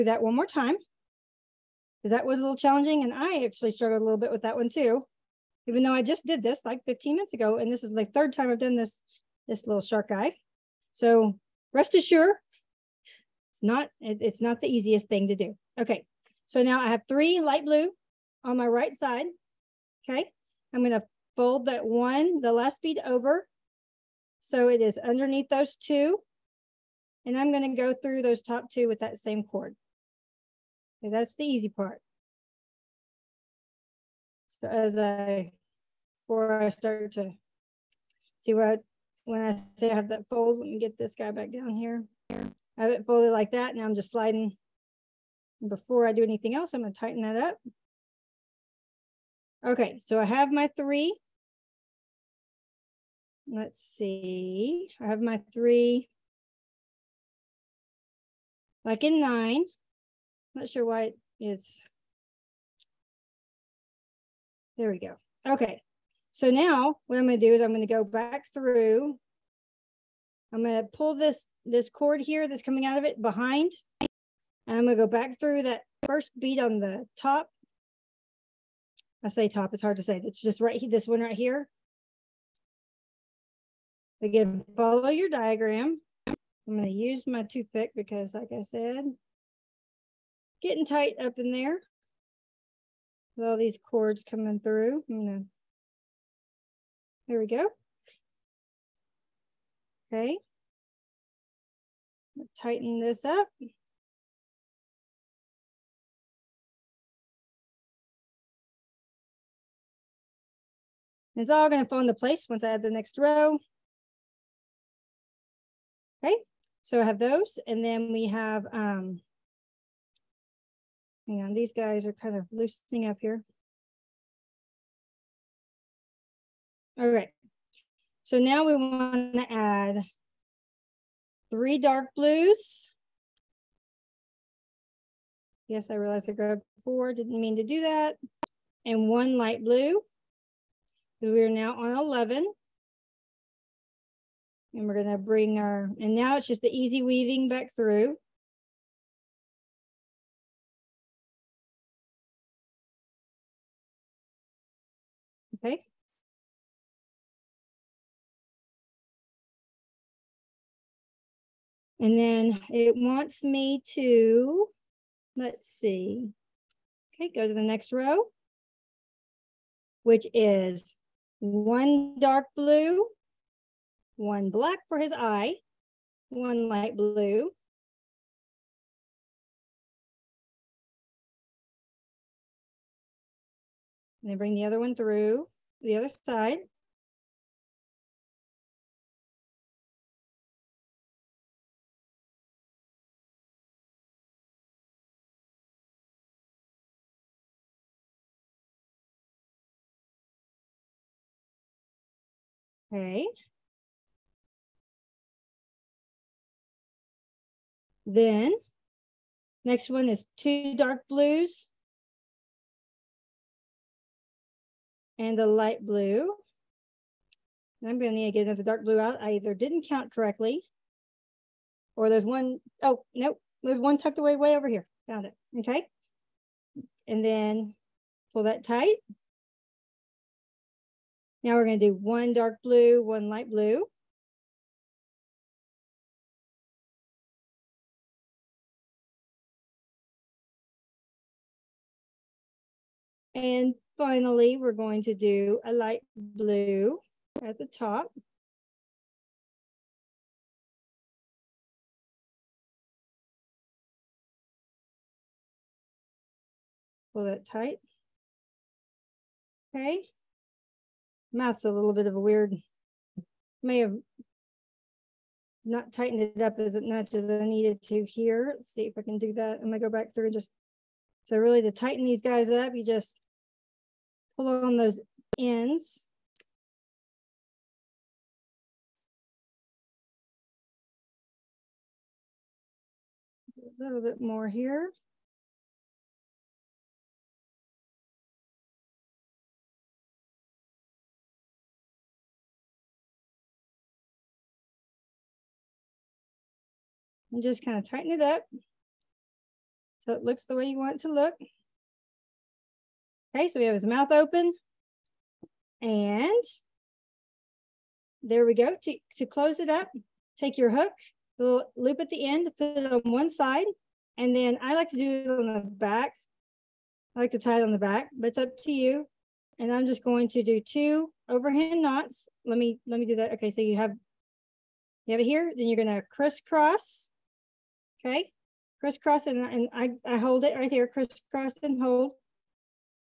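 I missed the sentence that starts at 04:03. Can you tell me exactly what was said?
And Finally, we're going to do a light blue at the top.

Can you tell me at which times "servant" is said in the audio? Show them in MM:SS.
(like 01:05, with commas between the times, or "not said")
not said.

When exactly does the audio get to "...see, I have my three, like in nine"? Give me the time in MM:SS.
00:53.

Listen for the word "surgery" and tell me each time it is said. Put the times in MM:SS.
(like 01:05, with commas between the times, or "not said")
not said.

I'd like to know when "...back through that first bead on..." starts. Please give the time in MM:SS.
01:15.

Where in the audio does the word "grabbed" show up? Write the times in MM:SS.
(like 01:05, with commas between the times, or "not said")
02:16.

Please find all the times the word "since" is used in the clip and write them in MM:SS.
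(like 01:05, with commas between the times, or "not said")
not said.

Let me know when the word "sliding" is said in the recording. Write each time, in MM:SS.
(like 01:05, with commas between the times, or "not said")
00:44.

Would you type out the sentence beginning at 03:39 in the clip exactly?
I either didn't count correctly or there's one, oh, nope, there's one tucked away way over here.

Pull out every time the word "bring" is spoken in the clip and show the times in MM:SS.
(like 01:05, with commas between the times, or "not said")
02:25, 03:04.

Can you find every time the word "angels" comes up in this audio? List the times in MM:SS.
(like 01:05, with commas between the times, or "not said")
not said.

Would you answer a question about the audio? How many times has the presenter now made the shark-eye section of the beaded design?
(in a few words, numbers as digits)
3.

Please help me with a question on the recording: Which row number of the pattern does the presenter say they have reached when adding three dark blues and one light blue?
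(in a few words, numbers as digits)
11.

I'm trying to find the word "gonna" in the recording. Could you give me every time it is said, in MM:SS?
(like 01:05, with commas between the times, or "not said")
00:46, 01:35, 02:25, 04:29, 05:25.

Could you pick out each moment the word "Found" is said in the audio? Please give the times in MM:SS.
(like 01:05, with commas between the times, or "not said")
03:45.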